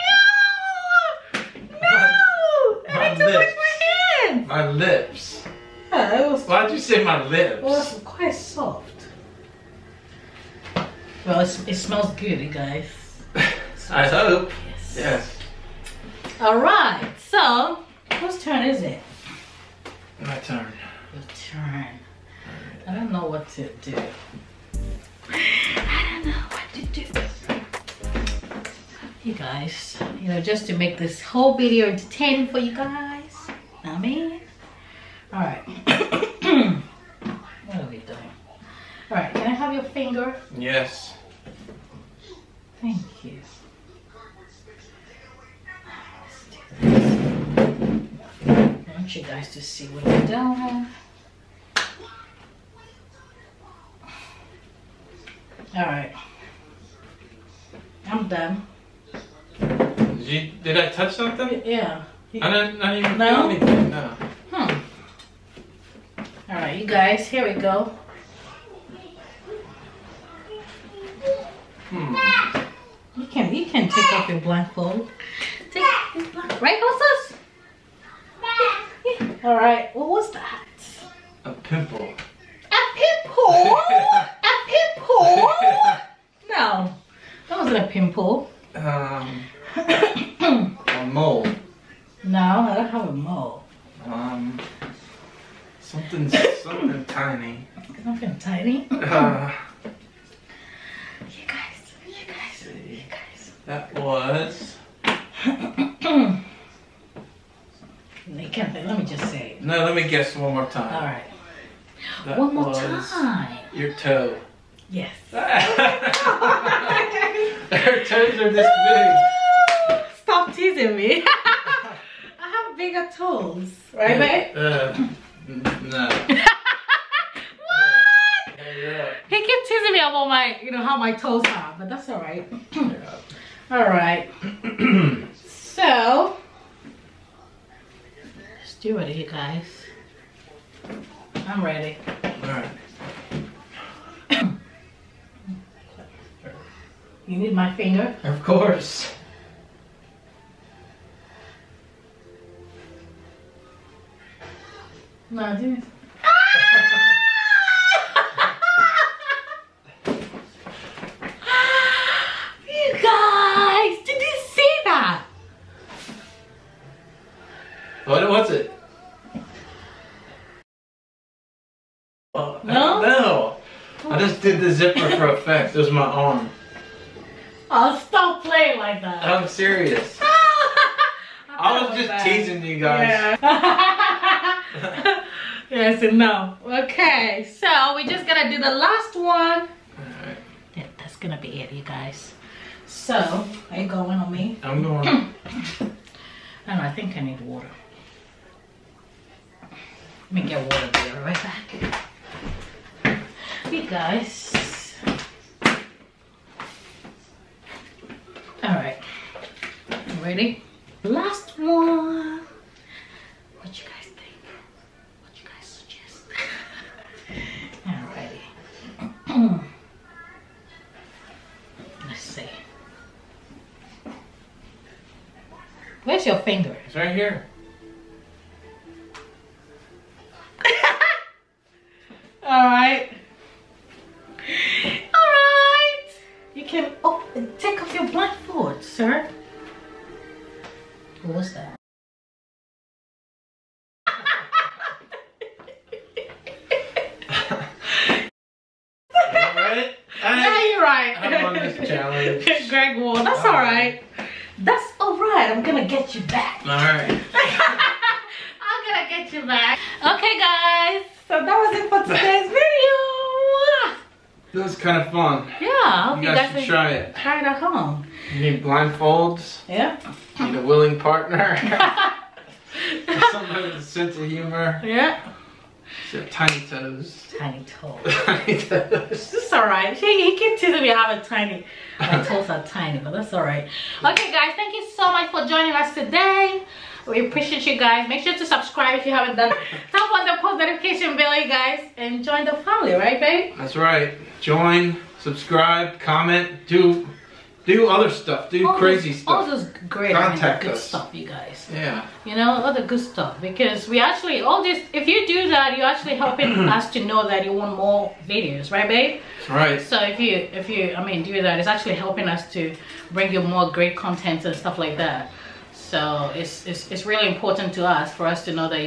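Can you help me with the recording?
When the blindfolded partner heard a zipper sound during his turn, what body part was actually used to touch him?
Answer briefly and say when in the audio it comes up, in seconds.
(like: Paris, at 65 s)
Arm, at 175 s.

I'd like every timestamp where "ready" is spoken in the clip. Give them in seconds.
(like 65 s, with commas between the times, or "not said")
141 s, 210 s.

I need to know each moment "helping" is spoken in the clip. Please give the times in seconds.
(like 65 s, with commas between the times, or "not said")
306 s, 311 s.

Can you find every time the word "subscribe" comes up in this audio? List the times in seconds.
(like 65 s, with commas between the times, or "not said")
288 s, 295 s.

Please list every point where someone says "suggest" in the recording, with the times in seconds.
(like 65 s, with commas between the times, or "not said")
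215 s.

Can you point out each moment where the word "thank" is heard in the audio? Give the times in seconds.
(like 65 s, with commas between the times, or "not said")
42 s, 284 s.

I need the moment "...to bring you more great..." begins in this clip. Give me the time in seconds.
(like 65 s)
312 s.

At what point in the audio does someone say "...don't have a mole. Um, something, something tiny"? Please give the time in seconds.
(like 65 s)
92 s.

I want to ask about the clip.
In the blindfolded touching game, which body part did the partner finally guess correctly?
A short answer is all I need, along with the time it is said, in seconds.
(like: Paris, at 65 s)
Toe, at 113 s.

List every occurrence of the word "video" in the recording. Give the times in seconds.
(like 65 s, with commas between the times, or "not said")
31 s, 262 s, 308 s.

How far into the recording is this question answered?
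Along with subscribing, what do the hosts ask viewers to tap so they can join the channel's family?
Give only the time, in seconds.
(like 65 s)
290 s.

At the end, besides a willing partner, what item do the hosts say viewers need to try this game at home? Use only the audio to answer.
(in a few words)
Blindfolds.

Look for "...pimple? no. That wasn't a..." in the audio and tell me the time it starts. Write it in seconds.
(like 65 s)
84 s.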